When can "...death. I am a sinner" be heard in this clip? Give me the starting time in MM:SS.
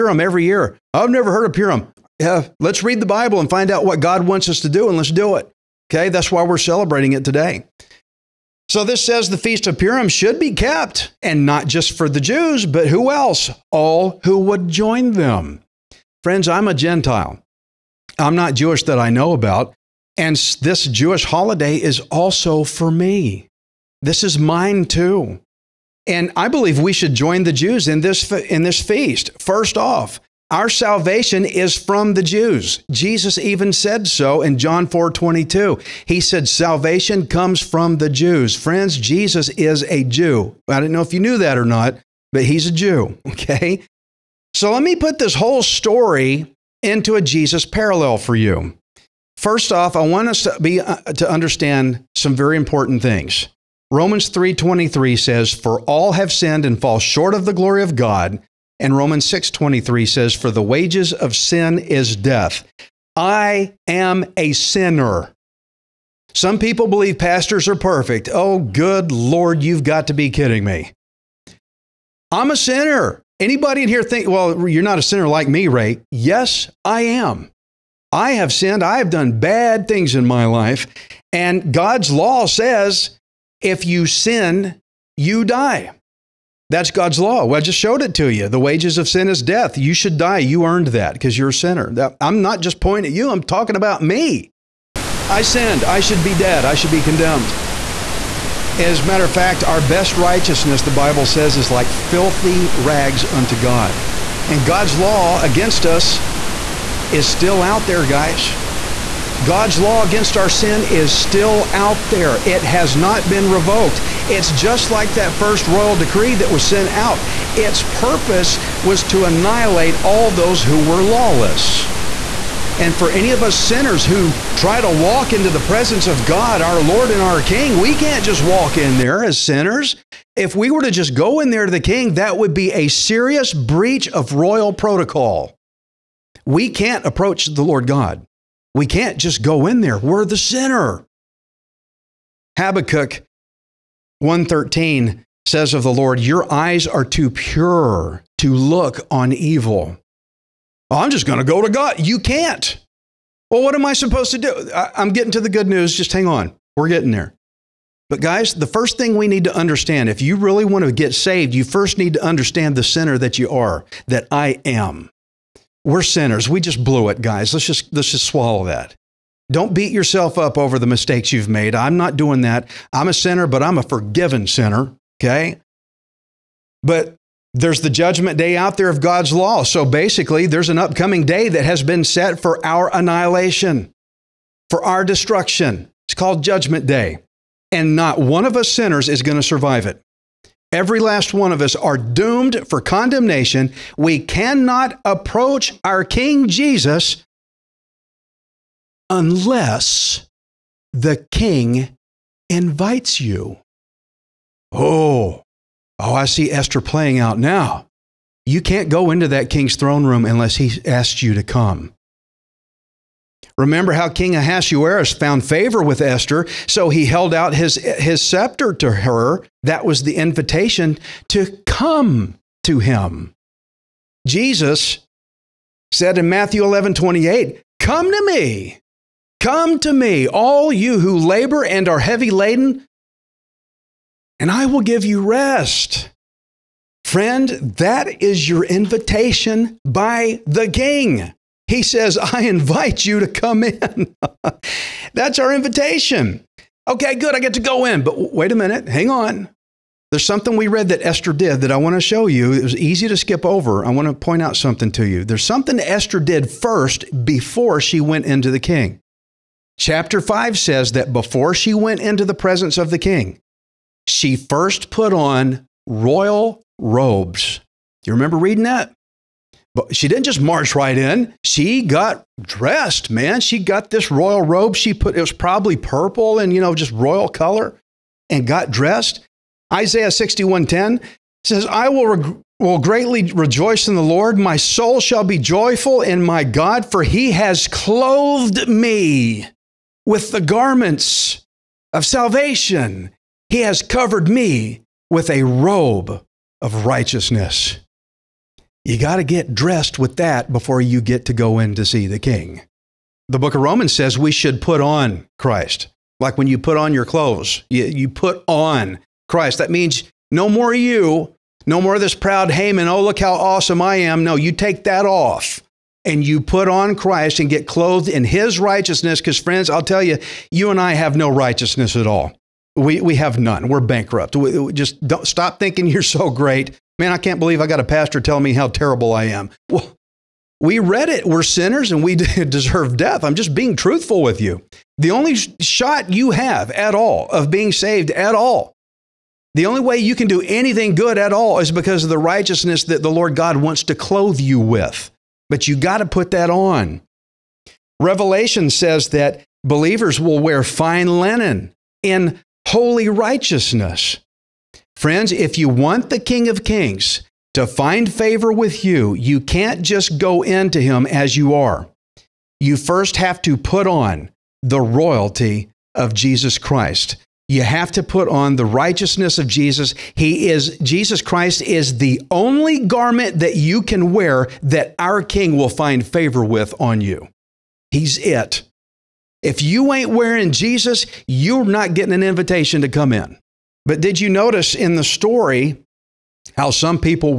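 01:02.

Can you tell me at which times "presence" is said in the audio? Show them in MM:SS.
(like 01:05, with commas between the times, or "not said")
02:05, 04:22.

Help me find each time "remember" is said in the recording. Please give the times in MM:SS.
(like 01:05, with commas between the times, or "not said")
03:33, 04:28.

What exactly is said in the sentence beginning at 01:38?
As a matter of fact, our best righteousness, the Bible says, is like filthy rags unto God.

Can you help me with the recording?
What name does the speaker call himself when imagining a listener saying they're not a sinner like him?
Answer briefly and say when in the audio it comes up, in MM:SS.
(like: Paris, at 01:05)
Ray, at 01:15.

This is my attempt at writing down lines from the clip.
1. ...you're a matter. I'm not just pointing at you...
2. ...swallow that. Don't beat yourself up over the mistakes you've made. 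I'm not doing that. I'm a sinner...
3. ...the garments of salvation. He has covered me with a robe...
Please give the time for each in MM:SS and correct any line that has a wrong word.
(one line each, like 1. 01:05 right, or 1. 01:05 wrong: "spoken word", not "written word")
1. 01:31 wrong: "sinner", not "matter"
2. 02:48 right
3. 04:50 right.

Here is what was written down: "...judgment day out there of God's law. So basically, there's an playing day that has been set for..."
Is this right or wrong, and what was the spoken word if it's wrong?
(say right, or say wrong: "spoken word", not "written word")
wrong: "upcoming", not "playing".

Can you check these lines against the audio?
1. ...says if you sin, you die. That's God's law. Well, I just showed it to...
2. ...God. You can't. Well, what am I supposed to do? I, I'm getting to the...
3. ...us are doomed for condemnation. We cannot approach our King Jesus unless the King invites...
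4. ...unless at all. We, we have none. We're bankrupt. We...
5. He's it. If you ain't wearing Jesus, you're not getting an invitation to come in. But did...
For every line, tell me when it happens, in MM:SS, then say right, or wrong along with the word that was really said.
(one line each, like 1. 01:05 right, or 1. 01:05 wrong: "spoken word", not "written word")
1. 01:22 right
2. 02:31 right
3. 03:11 right
4. 05:21 wrong: "righteousness", not "unless"
5. 06:17 right.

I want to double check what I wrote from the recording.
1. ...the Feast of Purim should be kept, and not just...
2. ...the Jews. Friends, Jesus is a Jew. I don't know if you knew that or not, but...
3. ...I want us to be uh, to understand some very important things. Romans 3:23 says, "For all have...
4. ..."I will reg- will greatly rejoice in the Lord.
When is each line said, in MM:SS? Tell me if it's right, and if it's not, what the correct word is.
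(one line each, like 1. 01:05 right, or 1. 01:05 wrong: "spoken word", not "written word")
1. 00:09 right
2. 00:37 right
3. 00:49 right
4. 04:41 right.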